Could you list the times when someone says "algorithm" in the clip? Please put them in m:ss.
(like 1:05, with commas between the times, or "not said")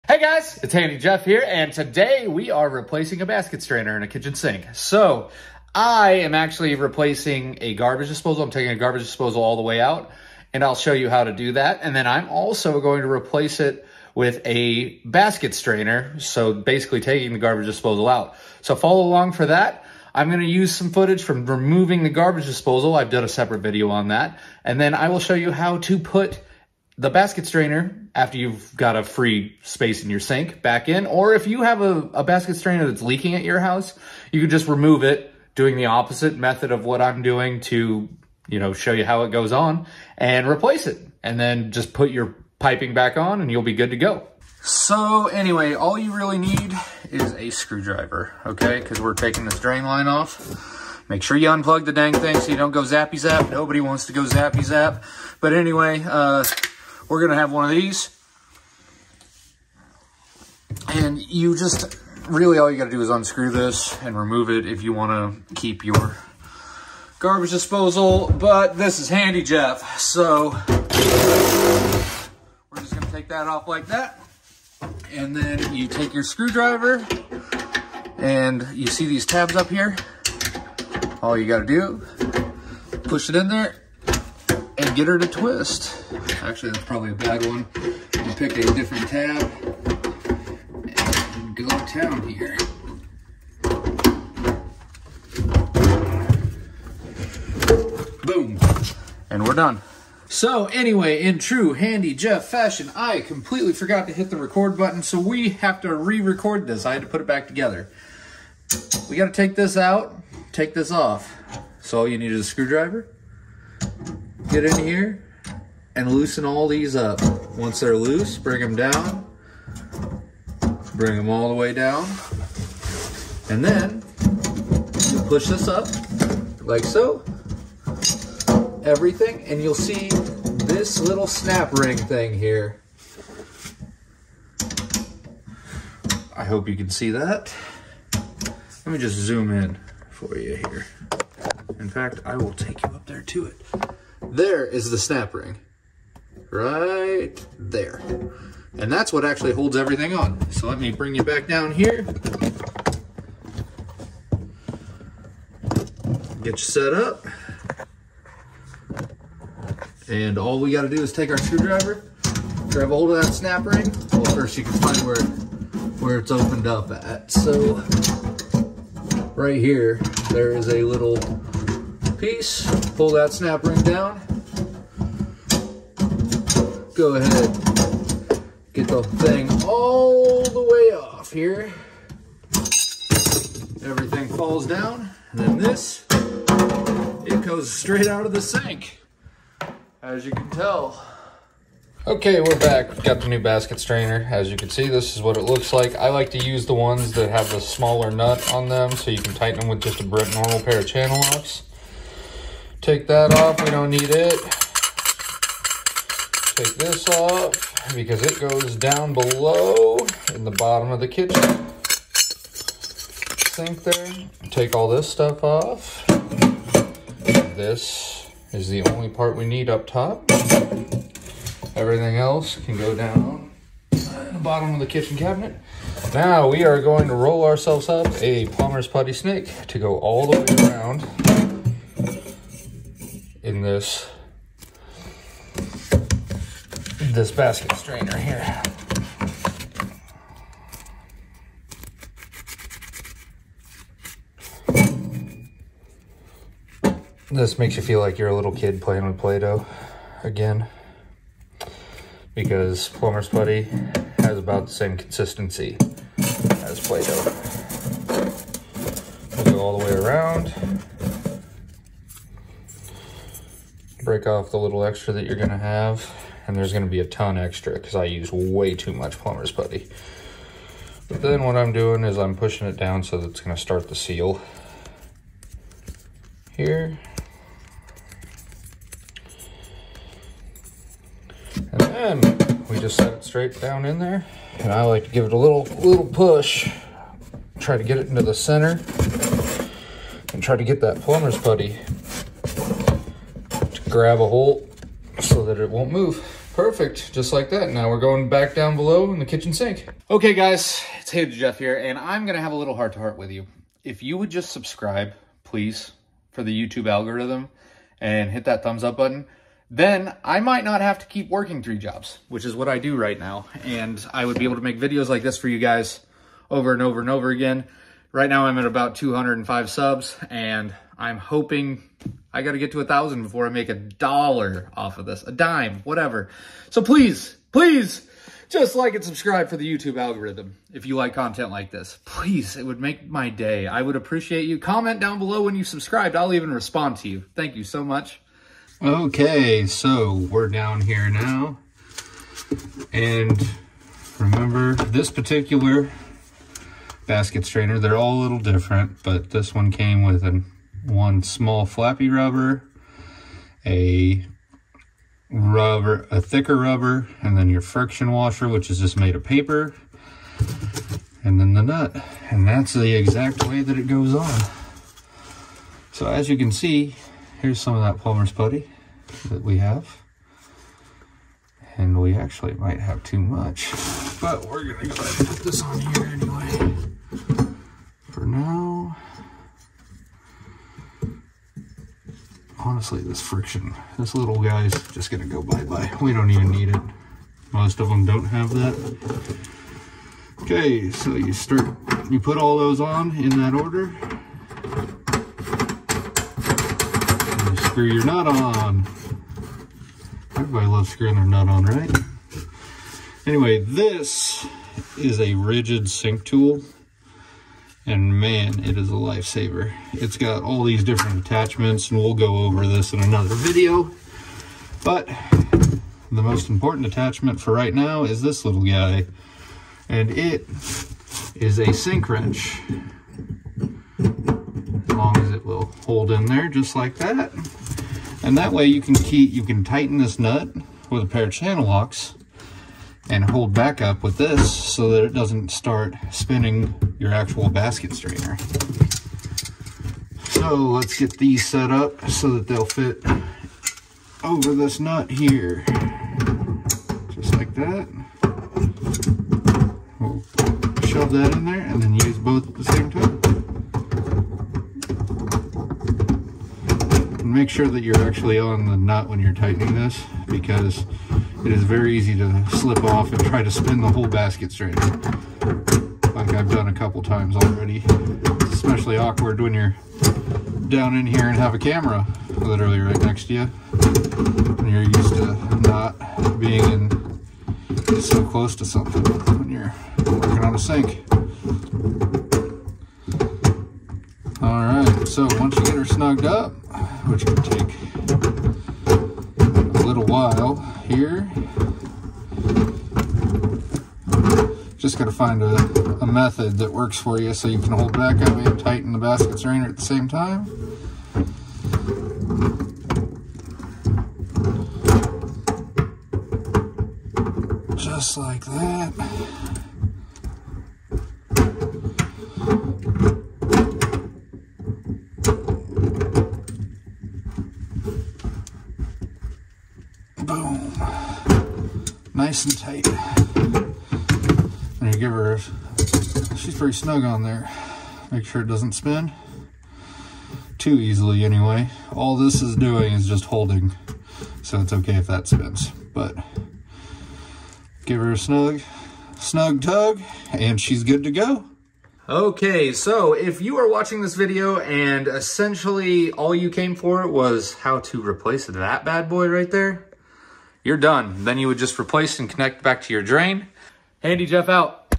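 5:06, 5:29.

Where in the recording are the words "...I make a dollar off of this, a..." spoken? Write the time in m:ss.
5:23.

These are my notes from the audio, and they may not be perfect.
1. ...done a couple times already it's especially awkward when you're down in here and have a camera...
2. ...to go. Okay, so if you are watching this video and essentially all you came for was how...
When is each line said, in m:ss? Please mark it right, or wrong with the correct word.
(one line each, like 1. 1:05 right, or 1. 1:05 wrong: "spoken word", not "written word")
1. 7:46 right
2. 9:01 right.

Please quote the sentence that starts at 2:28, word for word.
And that's what actually holds everything on.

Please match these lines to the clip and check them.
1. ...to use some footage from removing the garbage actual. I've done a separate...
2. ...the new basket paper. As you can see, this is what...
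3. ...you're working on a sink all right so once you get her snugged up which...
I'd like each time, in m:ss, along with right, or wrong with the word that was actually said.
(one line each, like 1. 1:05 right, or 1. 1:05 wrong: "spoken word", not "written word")
1. 0:20 wrong: "disposal", not "actual"
2. 3:13 wrong: "strainer", not "paper"
3. 7:59 right.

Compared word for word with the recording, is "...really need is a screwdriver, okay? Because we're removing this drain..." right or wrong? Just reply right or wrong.
wrong.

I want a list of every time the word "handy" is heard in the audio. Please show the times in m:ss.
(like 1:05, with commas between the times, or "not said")
0:00, 1:09, 1:41, 5:01, 9:14.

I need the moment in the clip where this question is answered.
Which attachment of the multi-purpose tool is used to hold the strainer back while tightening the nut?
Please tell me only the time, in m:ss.
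7:01.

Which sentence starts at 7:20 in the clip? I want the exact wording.
So let's get these set up so that they'll fit over this nut here.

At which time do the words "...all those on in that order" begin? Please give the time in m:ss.
6:32.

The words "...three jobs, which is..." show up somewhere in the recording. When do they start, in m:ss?
5:11.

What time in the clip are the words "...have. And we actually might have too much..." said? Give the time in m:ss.
6:09.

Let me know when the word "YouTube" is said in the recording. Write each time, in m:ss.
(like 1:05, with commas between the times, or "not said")
5:06, 5:29.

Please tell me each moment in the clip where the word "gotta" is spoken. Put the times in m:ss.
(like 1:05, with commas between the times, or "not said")
1:49, 2:40.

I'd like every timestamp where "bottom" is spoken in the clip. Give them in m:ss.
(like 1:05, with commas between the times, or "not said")
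3:30, 3:44.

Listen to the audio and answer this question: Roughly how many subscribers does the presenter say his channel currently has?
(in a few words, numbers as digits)
205.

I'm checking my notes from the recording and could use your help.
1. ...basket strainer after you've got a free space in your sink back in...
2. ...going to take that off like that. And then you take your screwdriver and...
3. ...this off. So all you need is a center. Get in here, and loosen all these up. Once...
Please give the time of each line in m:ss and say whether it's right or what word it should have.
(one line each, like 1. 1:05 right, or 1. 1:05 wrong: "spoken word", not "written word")
1. 0:27 right
2. 1:12 right
3. 1:50 wrong: "screwdriver", not "center".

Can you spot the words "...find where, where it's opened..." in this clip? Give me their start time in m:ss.
2:44.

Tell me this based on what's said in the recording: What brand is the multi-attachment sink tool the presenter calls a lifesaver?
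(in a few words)
Ridgid.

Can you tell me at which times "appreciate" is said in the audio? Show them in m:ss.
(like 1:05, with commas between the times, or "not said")
5:33.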